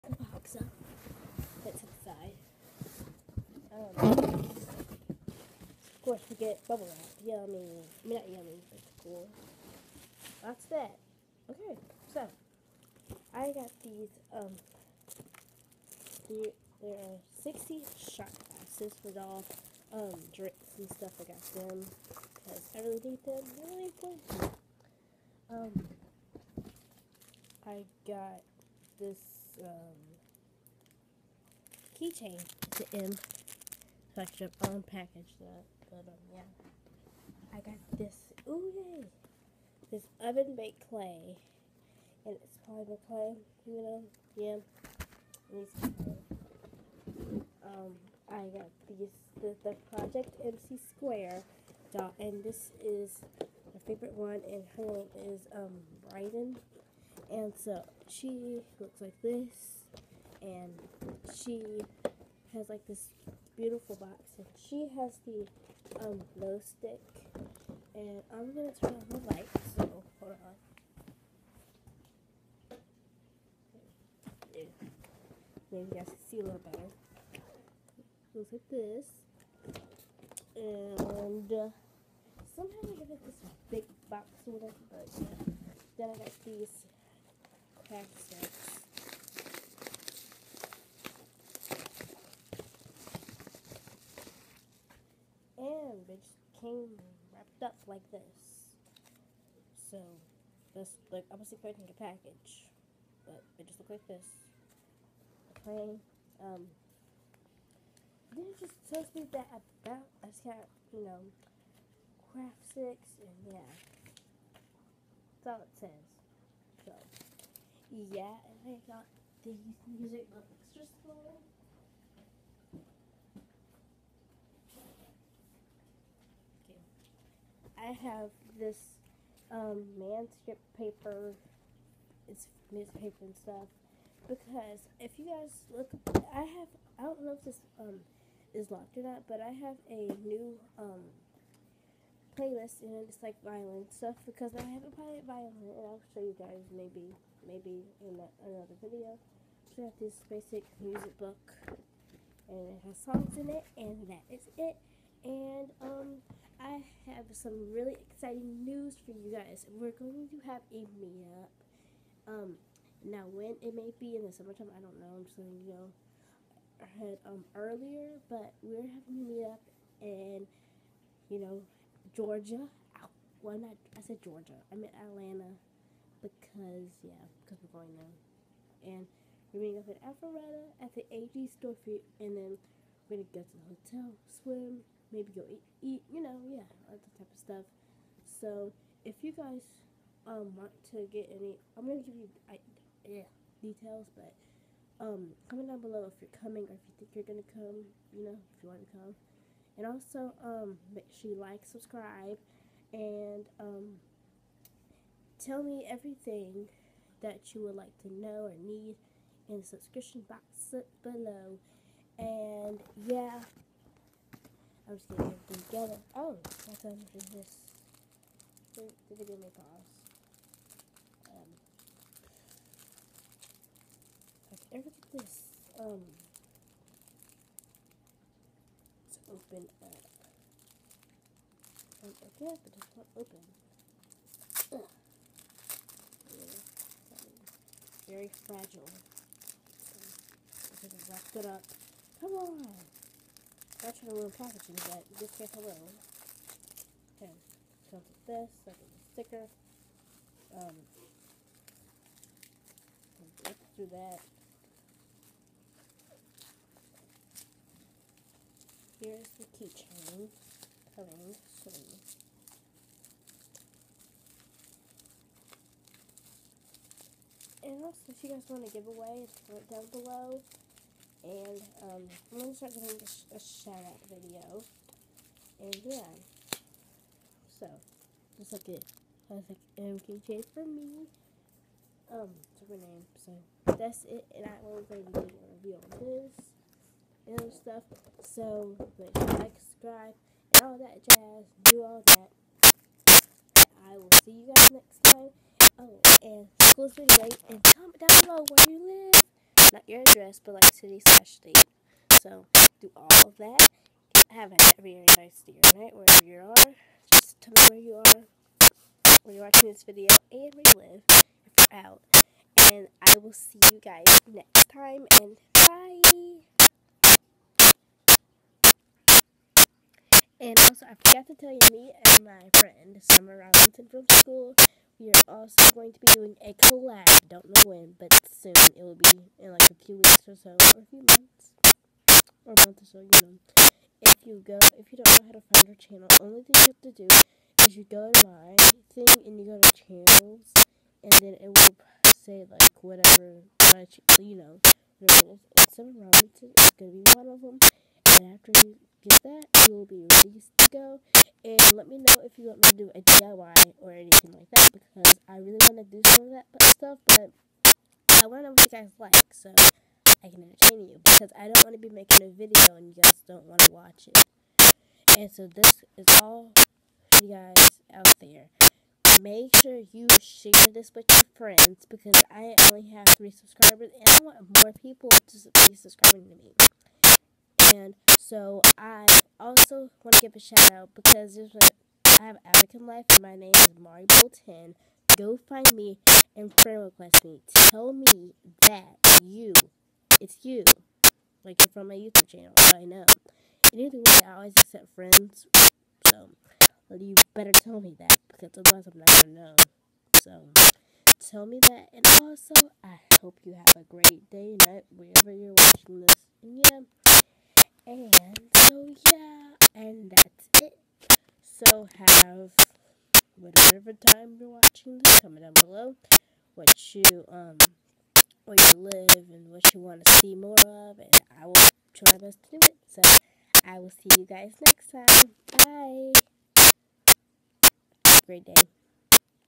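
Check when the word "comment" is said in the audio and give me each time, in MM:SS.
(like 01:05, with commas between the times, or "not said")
03:15, 06:55.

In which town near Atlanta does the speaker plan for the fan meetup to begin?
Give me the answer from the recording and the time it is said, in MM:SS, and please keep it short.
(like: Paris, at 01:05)
Alpharetta, at 03:00.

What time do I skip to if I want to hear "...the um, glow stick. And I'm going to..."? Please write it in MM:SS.
01:05.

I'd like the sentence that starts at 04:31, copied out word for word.
And um, I'm going to start doing a, a shout out video.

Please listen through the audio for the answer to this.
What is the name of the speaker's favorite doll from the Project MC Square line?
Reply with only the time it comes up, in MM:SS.
00:56.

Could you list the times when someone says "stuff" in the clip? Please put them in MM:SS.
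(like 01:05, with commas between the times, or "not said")
00:20, 02:13, 02:23, 03:07, 04:47, 05:56.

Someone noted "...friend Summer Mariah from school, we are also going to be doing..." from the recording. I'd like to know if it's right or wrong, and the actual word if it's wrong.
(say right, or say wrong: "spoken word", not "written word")
wrong: "Robinson", not "Mariah".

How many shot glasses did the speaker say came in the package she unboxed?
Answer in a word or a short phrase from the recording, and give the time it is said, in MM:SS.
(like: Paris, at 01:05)
60, at 00:17.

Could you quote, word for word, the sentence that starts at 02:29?
So I have this basic music book and it has songs in it and that is it.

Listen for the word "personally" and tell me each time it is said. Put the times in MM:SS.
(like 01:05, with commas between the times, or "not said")
not said.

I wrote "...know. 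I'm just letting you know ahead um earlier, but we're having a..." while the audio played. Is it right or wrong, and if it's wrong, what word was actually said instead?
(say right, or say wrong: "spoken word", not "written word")
right.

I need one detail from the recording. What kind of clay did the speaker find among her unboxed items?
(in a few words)
Oven baked clay.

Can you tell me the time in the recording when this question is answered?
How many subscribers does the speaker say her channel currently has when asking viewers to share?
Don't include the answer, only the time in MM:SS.
06:13.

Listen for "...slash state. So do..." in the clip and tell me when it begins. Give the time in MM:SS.
05:01.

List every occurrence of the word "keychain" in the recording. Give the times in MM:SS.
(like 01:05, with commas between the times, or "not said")
00:32, 04:19.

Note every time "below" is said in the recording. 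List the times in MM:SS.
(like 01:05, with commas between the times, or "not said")
03:15, 03:31, 04:29, 06:55.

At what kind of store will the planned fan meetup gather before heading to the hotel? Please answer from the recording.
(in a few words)
AG store.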